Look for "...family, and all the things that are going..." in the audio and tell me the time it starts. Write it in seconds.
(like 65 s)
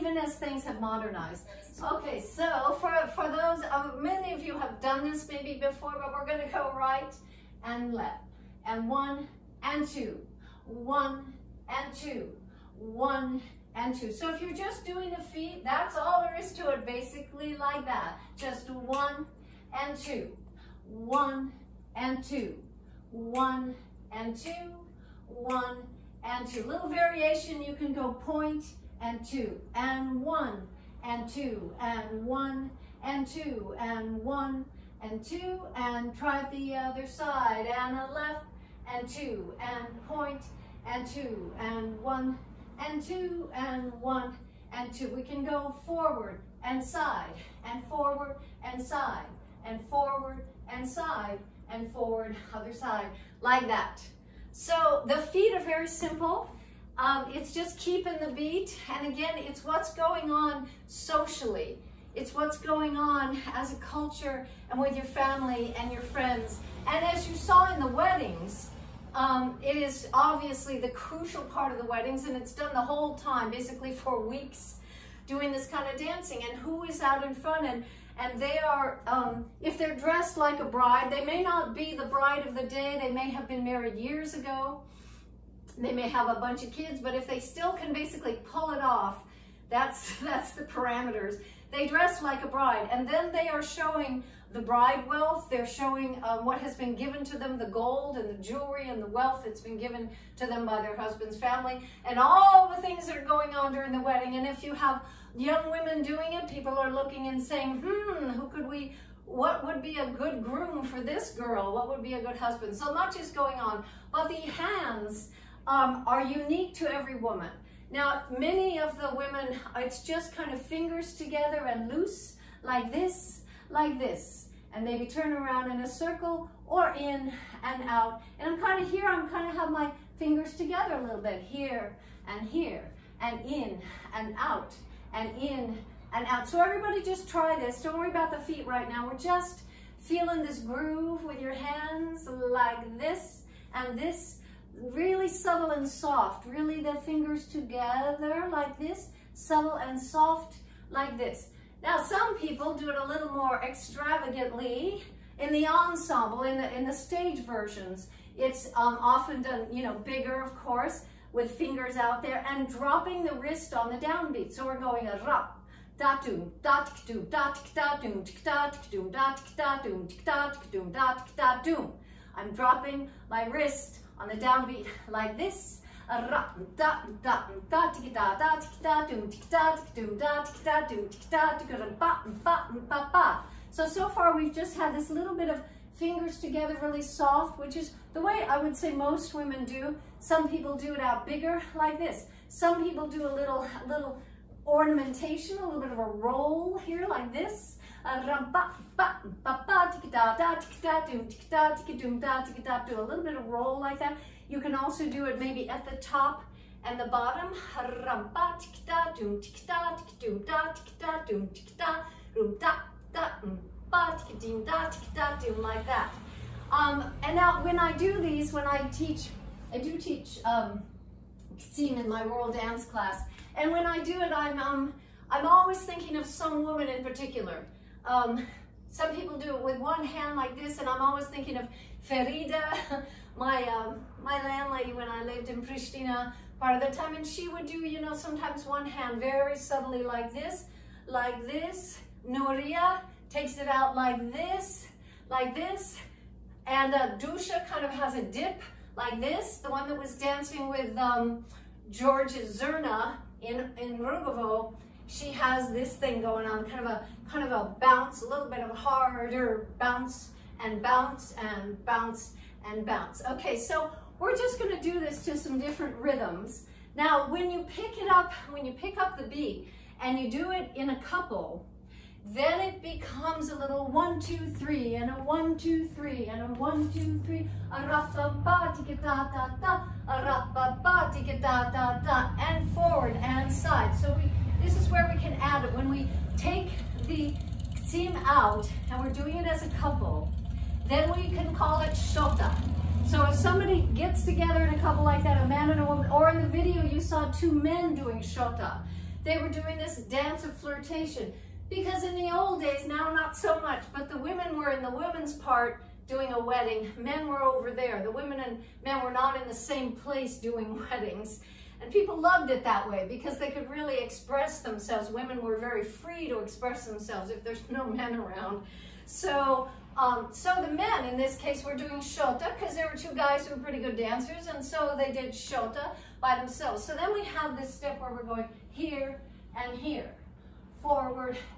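101 s.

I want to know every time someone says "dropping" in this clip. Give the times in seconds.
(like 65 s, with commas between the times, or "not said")
162 s, 172 s.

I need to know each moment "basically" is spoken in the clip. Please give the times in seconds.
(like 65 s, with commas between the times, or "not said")
16 s, 73 s, 87 s.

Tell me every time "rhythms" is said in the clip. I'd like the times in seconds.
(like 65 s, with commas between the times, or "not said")
265 s.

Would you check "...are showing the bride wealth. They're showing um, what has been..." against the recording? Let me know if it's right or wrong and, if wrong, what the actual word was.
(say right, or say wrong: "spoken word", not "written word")
right.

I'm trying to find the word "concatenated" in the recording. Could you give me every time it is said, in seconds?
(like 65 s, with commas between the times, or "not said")
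not said.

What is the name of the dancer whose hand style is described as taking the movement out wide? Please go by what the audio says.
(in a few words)
Nuria.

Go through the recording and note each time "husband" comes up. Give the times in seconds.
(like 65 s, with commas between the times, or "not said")
100 s, 112 s.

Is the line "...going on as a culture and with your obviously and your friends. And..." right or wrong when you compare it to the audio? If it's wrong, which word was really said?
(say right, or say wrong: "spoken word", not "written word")
wrong: "family", not "obviously".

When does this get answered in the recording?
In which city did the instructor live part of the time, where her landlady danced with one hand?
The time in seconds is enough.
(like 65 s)
235 s.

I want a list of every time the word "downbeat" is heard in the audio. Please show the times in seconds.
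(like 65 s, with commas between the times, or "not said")
164 s, 174 s.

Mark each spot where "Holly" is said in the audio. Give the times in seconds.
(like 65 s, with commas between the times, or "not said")
not said.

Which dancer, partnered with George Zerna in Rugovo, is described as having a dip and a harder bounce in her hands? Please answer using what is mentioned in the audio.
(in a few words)
Dusha.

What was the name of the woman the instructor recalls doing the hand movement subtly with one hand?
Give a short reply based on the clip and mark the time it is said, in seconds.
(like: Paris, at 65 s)
Ferida, at 232 s.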